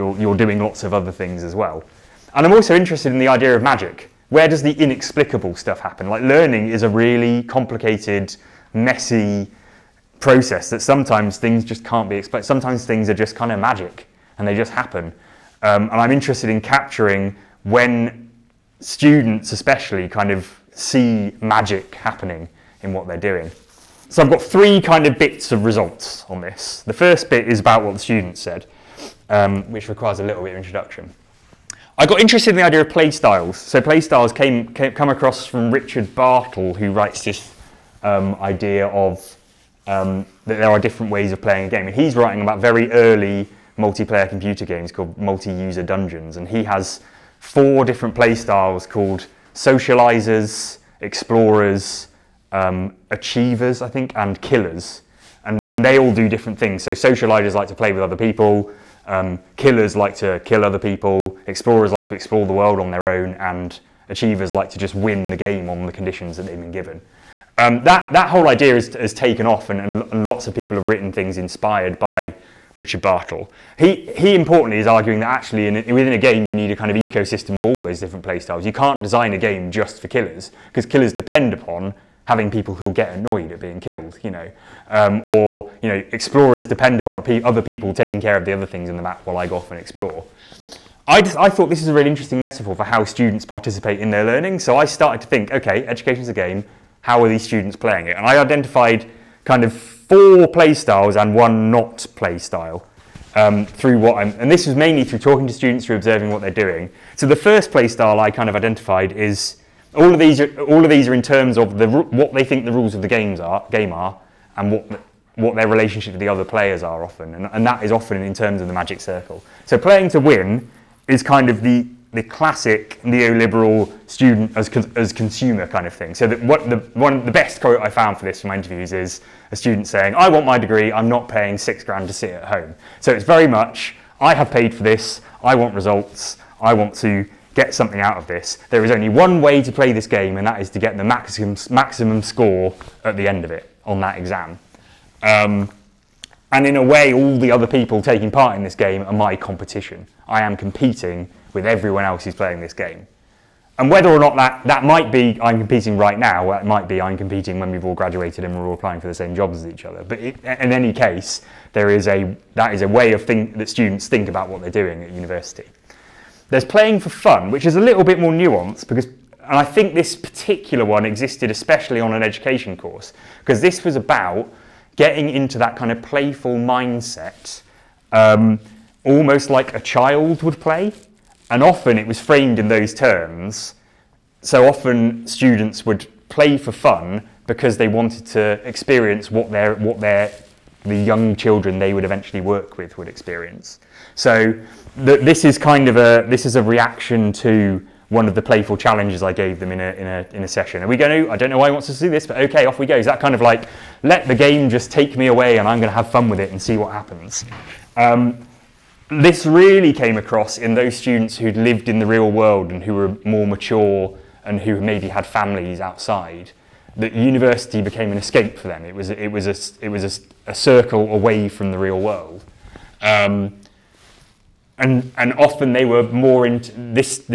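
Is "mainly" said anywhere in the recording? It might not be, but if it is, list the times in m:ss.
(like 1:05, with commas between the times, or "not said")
1:44.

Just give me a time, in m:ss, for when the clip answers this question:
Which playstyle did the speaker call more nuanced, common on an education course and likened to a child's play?
2:46.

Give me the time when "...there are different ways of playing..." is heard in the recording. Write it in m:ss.
0:40.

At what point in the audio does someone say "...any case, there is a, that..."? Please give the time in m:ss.
2:40.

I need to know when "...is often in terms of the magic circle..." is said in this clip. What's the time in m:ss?
1:57.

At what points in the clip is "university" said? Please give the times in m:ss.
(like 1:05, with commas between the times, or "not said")
2:45, 3:37.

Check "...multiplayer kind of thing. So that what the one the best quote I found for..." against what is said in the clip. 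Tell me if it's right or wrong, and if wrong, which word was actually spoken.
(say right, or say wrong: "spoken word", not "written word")
wrong: "consumer", not "multiplayer".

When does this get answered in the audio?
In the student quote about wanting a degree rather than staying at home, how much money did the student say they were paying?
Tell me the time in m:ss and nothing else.
2:11.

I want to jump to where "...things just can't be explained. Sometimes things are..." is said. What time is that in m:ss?
0:11.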